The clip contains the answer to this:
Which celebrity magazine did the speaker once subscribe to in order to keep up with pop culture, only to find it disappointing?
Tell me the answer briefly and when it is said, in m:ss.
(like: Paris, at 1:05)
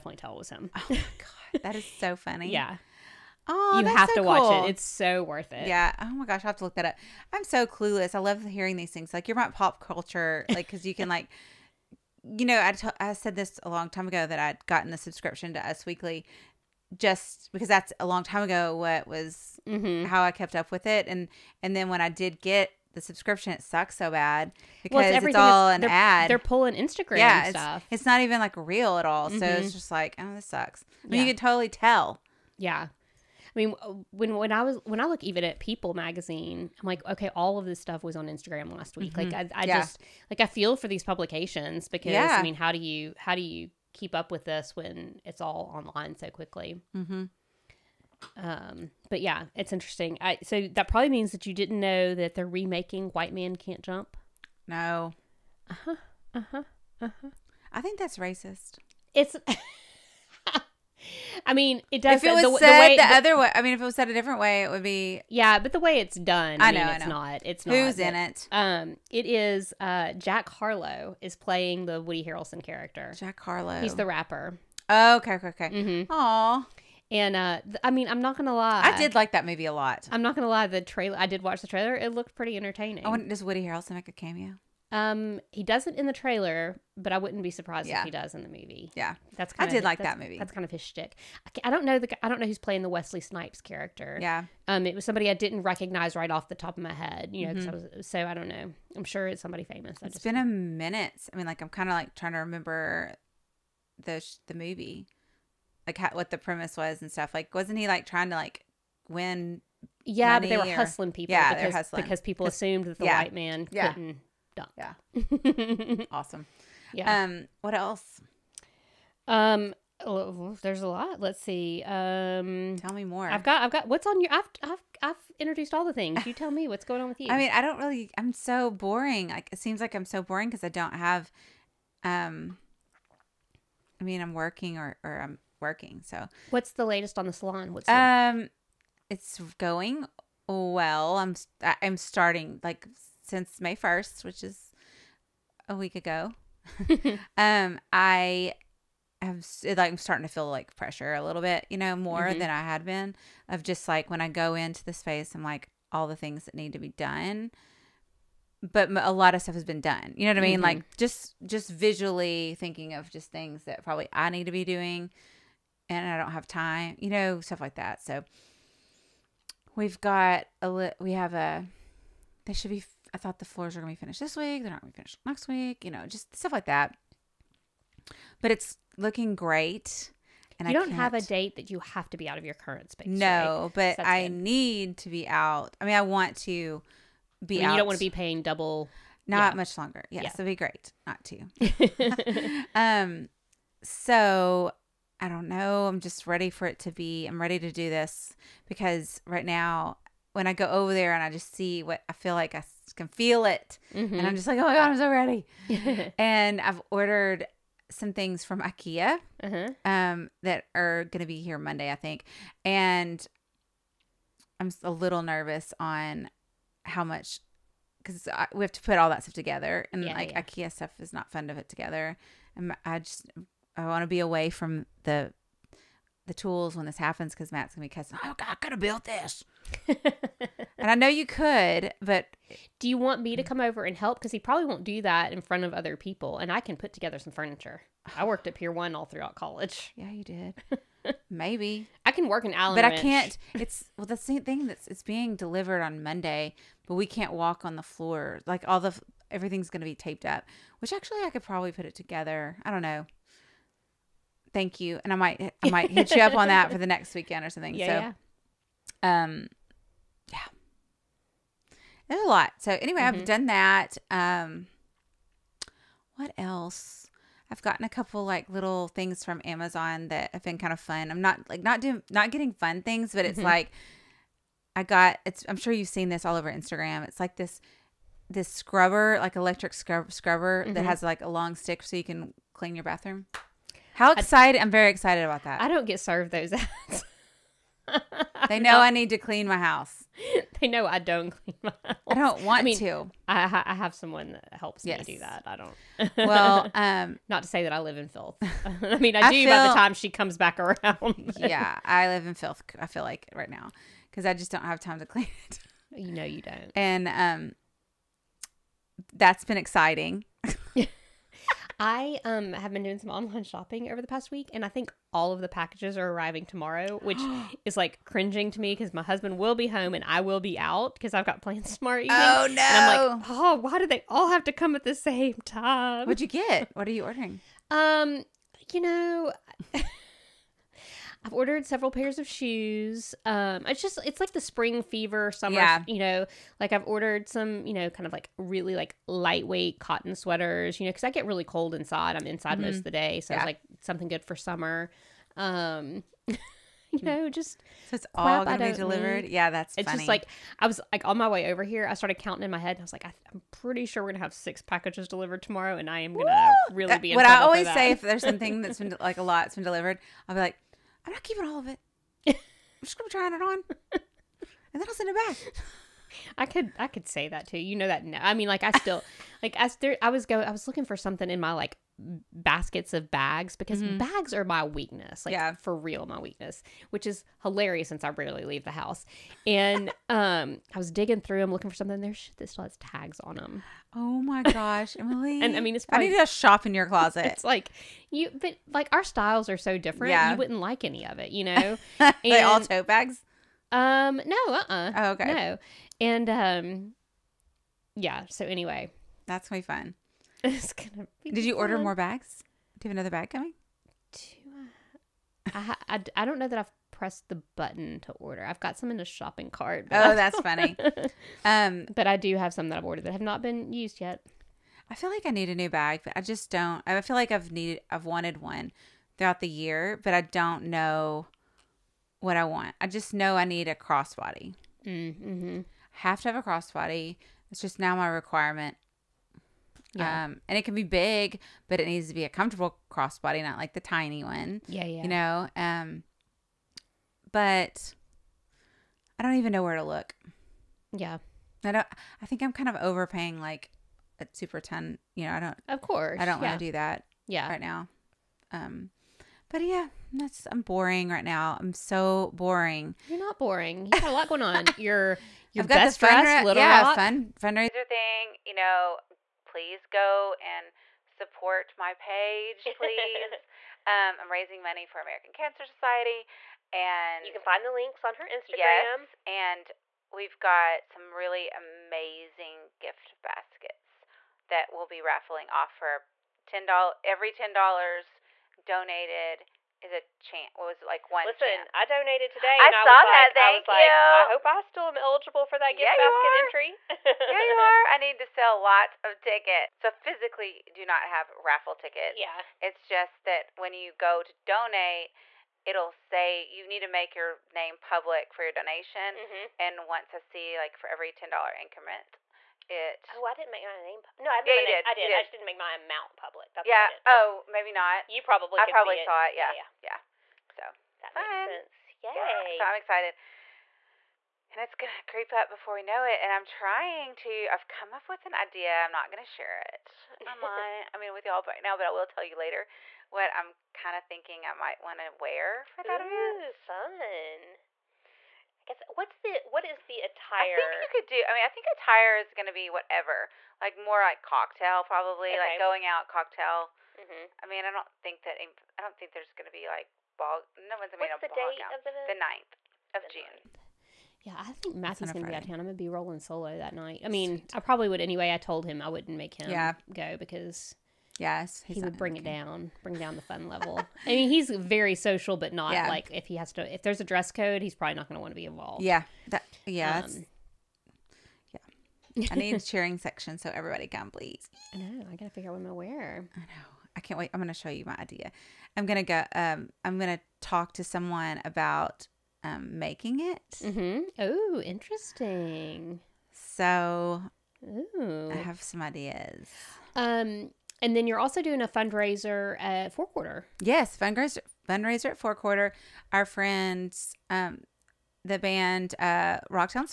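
Us Weekly, at 0:15.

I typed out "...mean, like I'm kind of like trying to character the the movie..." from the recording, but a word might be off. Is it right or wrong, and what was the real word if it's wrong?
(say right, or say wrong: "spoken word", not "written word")
wrong: "remember", not "character".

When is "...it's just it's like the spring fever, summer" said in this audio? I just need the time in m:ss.
5:33.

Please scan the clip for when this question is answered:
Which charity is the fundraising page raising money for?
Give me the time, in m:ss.
7:44.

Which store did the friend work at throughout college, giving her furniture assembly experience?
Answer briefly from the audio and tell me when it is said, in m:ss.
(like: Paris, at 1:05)
Pier One, at 3:58.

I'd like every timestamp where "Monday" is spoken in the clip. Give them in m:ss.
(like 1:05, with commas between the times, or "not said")
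3:31, 4:06.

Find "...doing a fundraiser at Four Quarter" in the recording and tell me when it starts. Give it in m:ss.
9:41.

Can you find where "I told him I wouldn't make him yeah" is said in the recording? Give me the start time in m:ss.
9:08.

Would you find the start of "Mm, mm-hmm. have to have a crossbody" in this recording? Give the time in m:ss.
7:04.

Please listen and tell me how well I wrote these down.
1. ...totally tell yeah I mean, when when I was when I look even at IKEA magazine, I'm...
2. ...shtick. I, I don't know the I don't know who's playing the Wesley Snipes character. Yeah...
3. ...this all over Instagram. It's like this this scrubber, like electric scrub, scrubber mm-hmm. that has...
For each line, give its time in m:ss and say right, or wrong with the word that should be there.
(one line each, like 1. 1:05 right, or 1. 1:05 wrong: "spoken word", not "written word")
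1. 0:31 wrong: "People", not "IKEA"
2. 1:30 right
3. 4:36 right.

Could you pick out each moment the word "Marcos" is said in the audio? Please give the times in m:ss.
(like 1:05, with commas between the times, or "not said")
not said.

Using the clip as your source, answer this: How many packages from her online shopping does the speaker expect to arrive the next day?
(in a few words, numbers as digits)
6.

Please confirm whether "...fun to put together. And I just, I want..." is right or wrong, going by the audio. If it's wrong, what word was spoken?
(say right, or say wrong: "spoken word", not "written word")
right.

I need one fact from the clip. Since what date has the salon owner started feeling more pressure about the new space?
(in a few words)
May 1st.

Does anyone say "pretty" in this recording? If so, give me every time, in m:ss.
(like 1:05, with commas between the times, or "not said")
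1:22, 5:53.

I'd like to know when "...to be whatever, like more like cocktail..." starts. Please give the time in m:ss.
8:52.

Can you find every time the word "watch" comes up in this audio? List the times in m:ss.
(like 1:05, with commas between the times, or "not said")
0:04, 1:21.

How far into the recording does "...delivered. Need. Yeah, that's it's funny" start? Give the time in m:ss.
5:48.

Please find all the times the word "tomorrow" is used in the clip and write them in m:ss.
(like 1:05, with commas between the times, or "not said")
5:16, 5:21, 5:55.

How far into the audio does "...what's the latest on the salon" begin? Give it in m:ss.
2:16.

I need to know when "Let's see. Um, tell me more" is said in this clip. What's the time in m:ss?
2:01.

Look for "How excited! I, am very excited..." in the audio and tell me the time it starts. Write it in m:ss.
4:43.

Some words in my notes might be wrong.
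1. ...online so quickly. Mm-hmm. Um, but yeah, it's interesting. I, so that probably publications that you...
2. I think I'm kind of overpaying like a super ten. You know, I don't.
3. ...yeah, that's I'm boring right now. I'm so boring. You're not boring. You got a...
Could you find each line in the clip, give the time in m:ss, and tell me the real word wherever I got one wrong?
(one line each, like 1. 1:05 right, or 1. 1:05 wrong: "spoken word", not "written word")
1. 0:45 wrong: "means", not "publications"
2. 7:22 right
3. 7:29 right.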